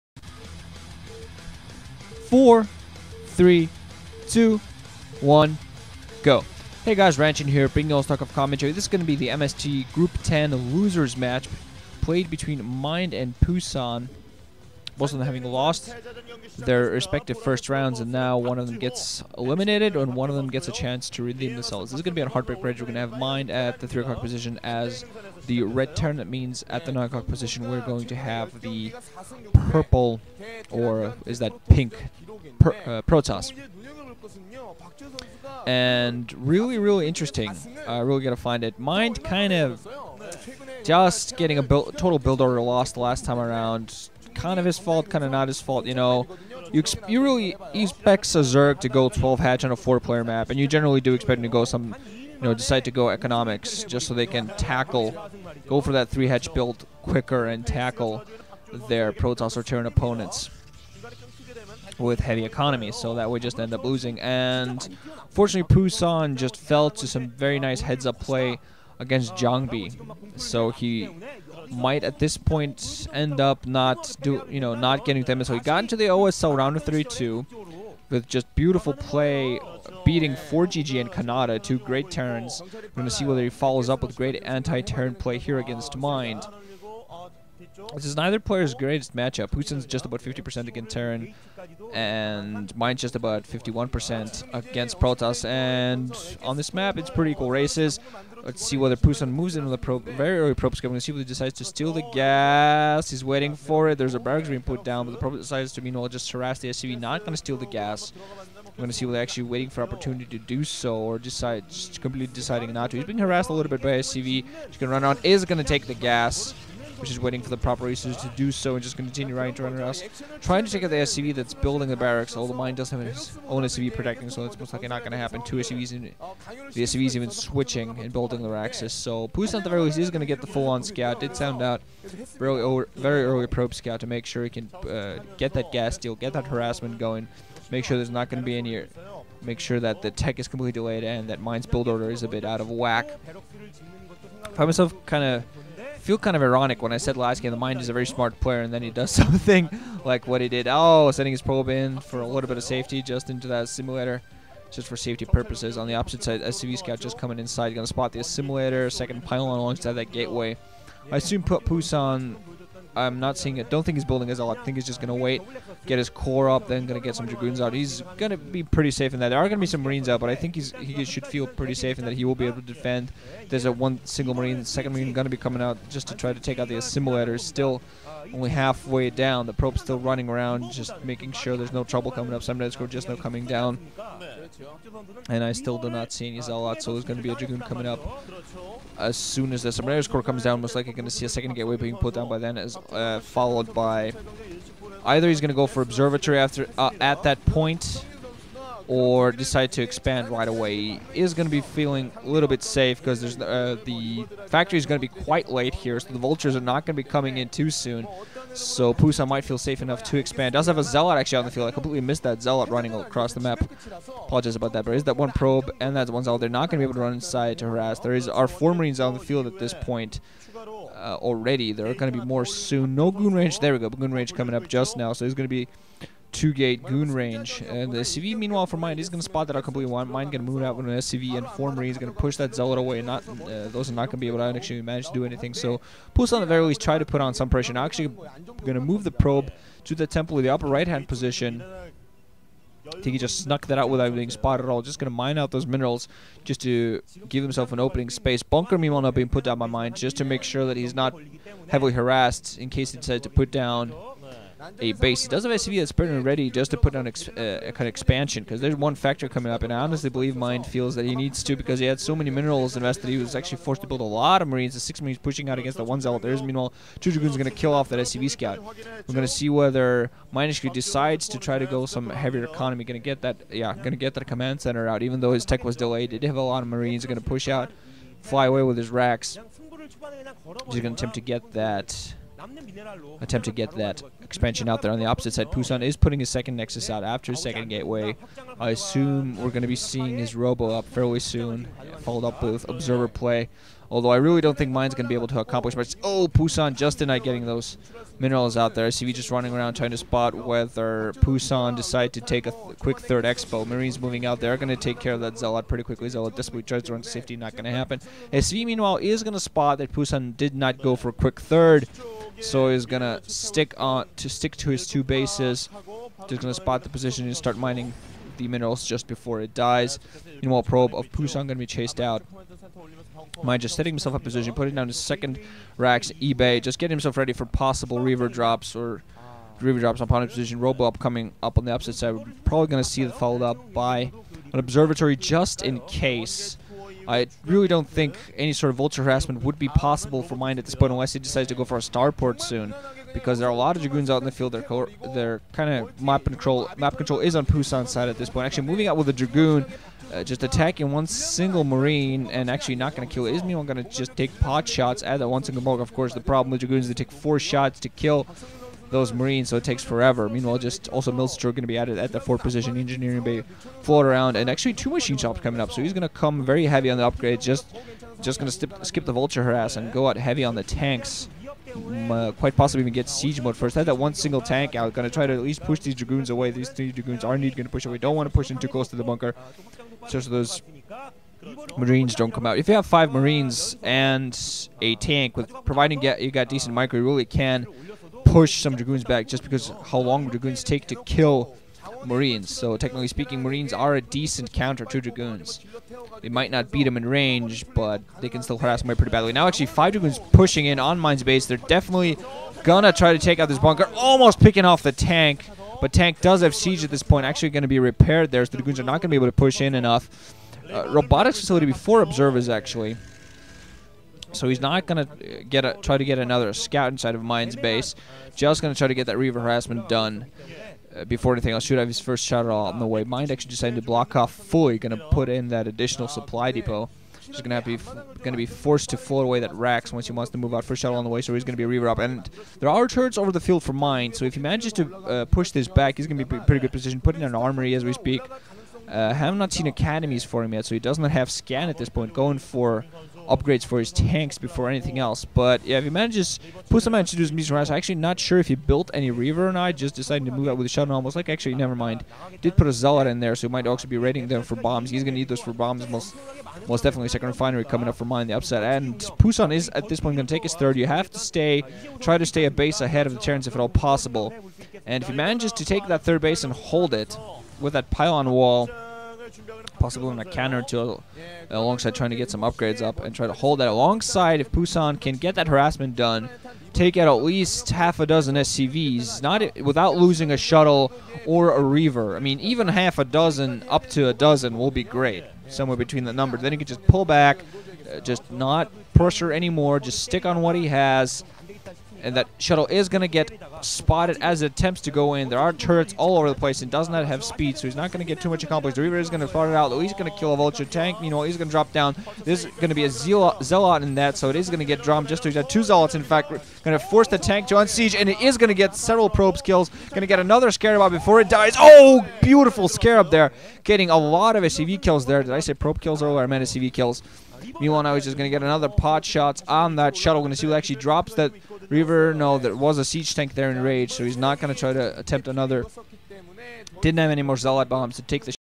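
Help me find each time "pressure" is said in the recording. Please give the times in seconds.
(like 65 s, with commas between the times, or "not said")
237 s, 488 s.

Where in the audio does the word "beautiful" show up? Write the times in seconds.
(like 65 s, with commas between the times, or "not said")
78 s, 512 s.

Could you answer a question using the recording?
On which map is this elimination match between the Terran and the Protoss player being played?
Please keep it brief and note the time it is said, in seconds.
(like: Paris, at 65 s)
Heartbreak Ridge, at 22 s.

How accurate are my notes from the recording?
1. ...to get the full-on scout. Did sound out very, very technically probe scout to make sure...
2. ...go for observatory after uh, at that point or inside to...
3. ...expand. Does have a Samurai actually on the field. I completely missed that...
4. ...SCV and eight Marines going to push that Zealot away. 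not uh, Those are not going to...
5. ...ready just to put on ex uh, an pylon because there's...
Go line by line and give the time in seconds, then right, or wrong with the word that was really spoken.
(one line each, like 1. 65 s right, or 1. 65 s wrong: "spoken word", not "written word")
1. 130 s wrong: "early", not "technically"
2. 195 s wrong: "decide", not "inside"
3. 210 s wrong: "Zealot", not "Samurai"
4. 230 s wrong: "four", not "eight"
5. 256 s wrong: "expansion", not "pylon".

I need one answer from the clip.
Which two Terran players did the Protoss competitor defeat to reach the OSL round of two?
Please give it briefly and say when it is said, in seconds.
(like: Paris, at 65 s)
ForGG and Kanata, at 80 s.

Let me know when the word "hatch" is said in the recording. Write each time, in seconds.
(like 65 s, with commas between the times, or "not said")
49 s, 56 s.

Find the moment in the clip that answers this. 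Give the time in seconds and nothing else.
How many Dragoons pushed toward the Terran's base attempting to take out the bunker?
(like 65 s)
399 s.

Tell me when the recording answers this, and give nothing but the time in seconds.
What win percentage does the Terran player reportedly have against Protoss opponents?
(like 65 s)
93 s.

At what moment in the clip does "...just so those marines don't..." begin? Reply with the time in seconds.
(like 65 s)
380 s.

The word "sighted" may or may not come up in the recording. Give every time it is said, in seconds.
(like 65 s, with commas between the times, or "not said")
not said.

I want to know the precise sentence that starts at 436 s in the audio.
Putting an armory as we speak.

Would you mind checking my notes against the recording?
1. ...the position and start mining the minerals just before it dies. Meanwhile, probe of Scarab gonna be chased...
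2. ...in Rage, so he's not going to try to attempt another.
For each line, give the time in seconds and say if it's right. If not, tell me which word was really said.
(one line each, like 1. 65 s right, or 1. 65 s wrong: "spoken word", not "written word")
1. 316 s wrong: "Pusan", not "Scarab"
2. 523 s right.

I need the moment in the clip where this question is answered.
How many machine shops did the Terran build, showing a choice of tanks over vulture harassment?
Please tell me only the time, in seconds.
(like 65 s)
364 s.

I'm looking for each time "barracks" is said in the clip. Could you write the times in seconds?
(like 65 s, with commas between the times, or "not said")
104 s, 121 s.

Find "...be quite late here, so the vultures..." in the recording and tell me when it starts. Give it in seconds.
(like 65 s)
205 s.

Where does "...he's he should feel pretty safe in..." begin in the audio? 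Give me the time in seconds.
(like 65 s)
170 s.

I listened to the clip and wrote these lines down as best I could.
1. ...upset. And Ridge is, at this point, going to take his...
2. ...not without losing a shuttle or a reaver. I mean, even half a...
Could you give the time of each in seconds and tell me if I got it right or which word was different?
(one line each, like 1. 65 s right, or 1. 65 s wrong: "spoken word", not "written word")
1. 458 s wrong: "Pusan", not "Ridge"
2. 479 s right.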